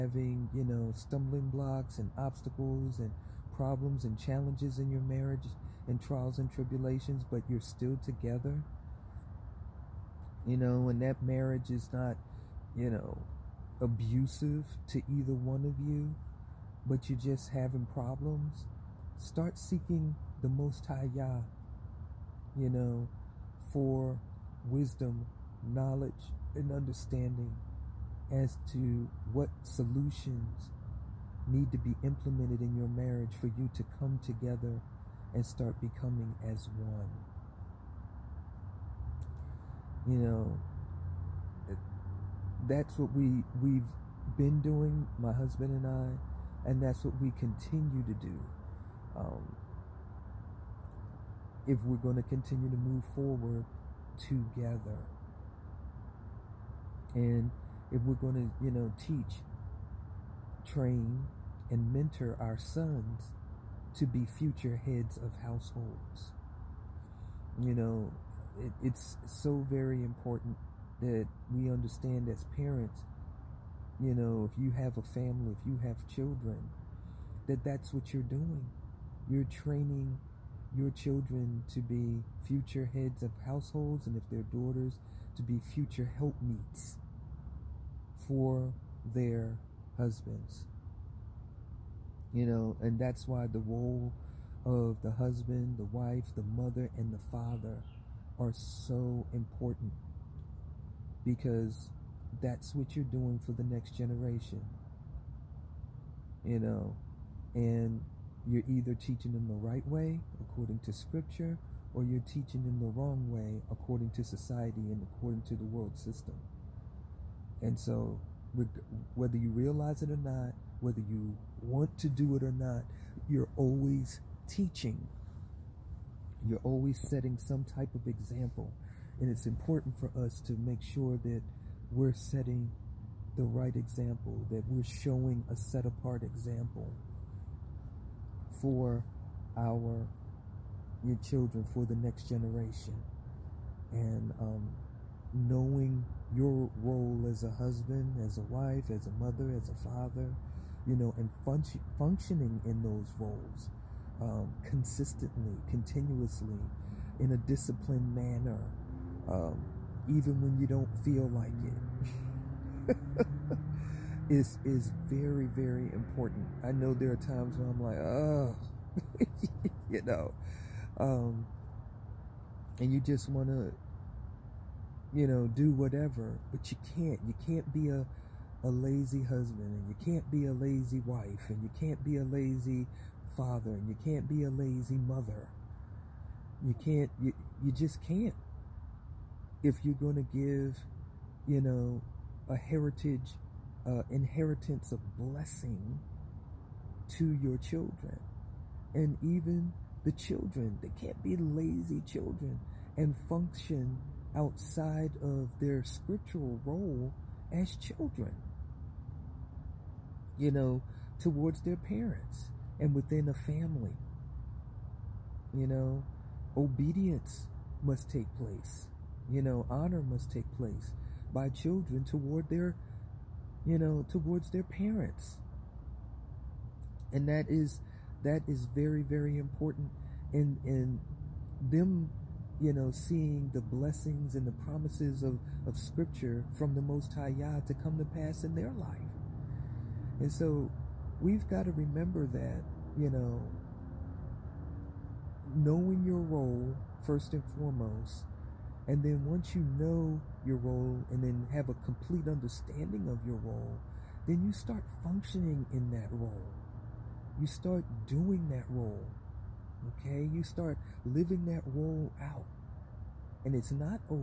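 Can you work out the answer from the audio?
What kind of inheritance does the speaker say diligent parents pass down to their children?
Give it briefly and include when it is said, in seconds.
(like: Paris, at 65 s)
blessing, at 195 s.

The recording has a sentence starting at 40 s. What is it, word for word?
You know, that's what we we've been doing, my husband and I, and that's what we continue to do.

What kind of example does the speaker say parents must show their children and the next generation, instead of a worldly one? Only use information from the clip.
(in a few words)
set apart.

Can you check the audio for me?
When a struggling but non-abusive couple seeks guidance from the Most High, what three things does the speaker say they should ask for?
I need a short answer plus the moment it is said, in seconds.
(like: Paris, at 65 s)
wisdom, knowledge, and understanding, at 24 s.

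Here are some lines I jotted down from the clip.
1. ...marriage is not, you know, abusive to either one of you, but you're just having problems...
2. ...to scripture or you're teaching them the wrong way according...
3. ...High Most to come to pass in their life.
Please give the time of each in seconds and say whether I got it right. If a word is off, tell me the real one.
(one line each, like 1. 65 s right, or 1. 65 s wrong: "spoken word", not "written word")
1. 11 s right
2. 110 s right
3. 237 s wrong: "Yah", not "Most".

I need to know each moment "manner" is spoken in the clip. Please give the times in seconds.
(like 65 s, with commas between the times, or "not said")
158 s.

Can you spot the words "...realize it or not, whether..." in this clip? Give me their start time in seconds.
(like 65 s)
119 s.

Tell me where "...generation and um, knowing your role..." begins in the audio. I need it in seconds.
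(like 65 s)
142 s.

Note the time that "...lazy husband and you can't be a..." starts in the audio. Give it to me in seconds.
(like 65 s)
178 s.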